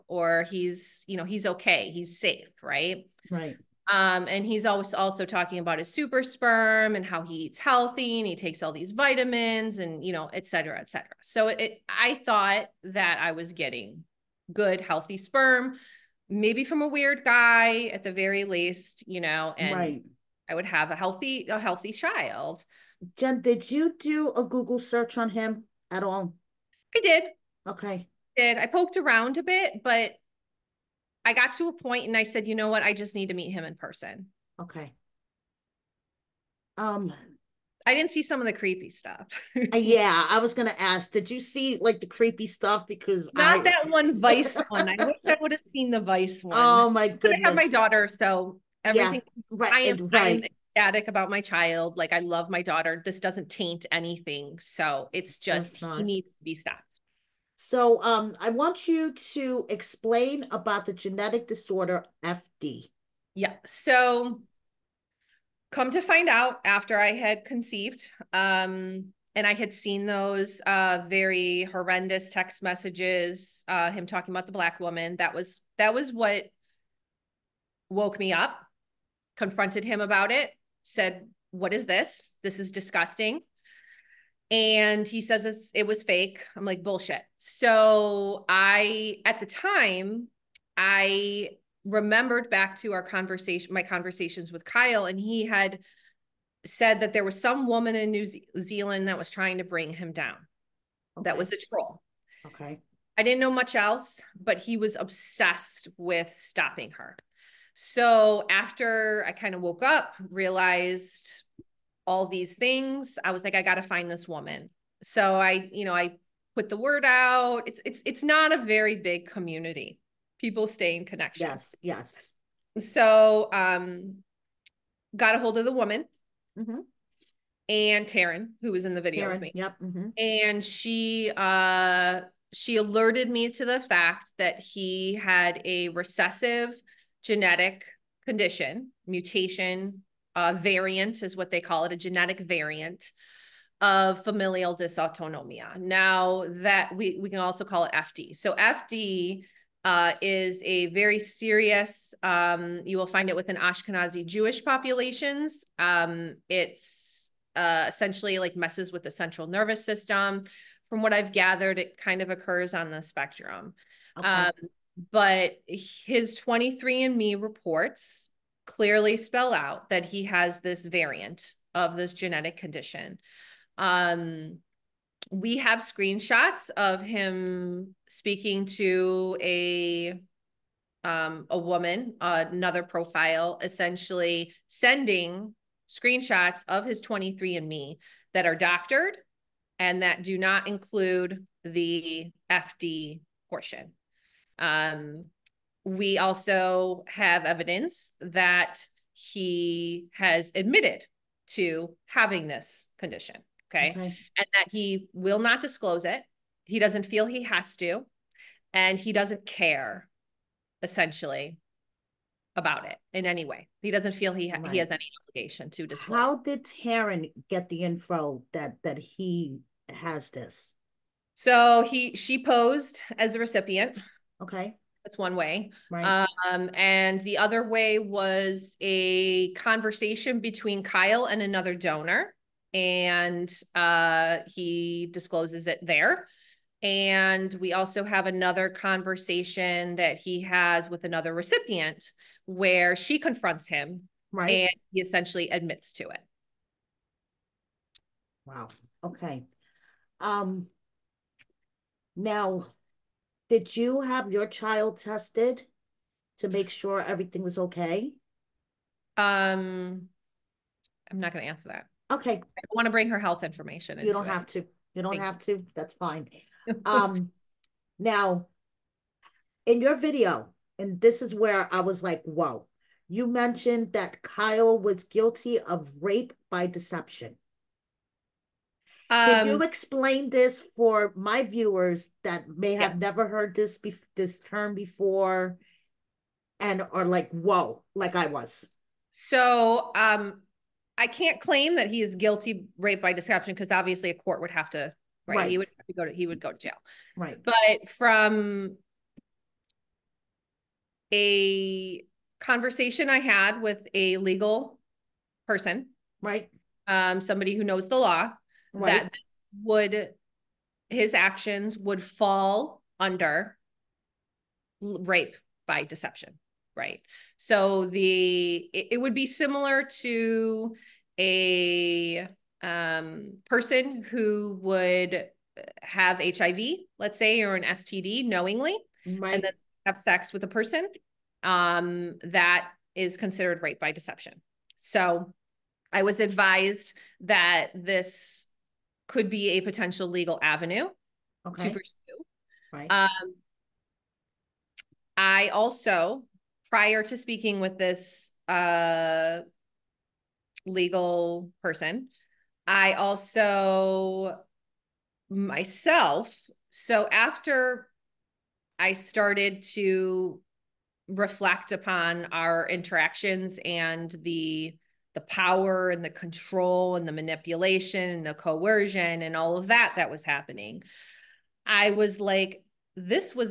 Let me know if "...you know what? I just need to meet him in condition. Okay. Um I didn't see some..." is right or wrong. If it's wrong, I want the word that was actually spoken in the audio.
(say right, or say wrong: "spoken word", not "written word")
wrong: "person", not "condition".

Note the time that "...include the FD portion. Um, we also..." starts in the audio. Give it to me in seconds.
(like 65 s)
190 s.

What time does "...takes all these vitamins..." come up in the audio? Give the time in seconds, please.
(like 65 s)
8 s.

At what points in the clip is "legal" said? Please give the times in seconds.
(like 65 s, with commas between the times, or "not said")
304 s, 340 s, 350 s.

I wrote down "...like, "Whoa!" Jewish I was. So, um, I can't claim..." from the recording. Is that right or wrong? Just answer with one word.
wrong.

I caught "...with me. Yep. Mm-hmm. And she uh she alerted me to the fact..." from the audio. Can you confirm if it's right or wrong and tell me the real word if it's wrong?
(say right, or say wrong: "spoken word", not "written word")
right.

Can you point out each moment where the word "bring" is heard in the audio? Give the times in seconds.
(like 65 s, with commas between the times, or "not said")
99 s, 262 s.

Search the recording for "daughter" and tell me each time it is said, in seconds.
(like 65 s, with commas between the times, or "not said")
47 s, 52 s.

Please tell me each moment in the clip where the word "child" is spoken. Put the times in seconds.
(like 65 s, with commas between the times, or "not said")
21 s, 51 s, 254 s.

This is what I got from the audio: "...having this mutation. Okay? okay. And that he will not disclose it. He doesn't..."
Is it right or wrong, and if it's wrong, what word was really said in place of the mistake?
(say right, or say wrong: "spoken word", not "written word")
wrong: "condition", not "mutation".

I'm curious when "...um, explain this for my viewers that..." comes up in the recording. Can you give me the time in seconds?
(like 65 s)
279 s.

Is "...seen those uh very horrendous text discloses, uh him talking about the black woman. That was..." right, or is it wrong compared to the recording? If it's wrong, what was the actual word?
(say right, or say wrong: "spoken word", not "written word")
wrong: "messages", not "discloses".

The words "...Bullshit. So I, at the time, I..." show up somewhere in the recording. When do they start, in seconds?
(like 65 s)
86 s.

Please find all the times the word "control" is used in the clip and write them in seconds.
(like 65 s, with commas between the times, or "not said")
366 s.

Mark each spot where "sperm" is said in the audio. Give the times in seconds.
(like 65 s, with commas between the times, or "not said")
6 s, 15 s.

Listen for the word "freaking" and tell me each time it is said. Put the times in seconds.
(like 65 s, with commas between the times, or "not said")
not said.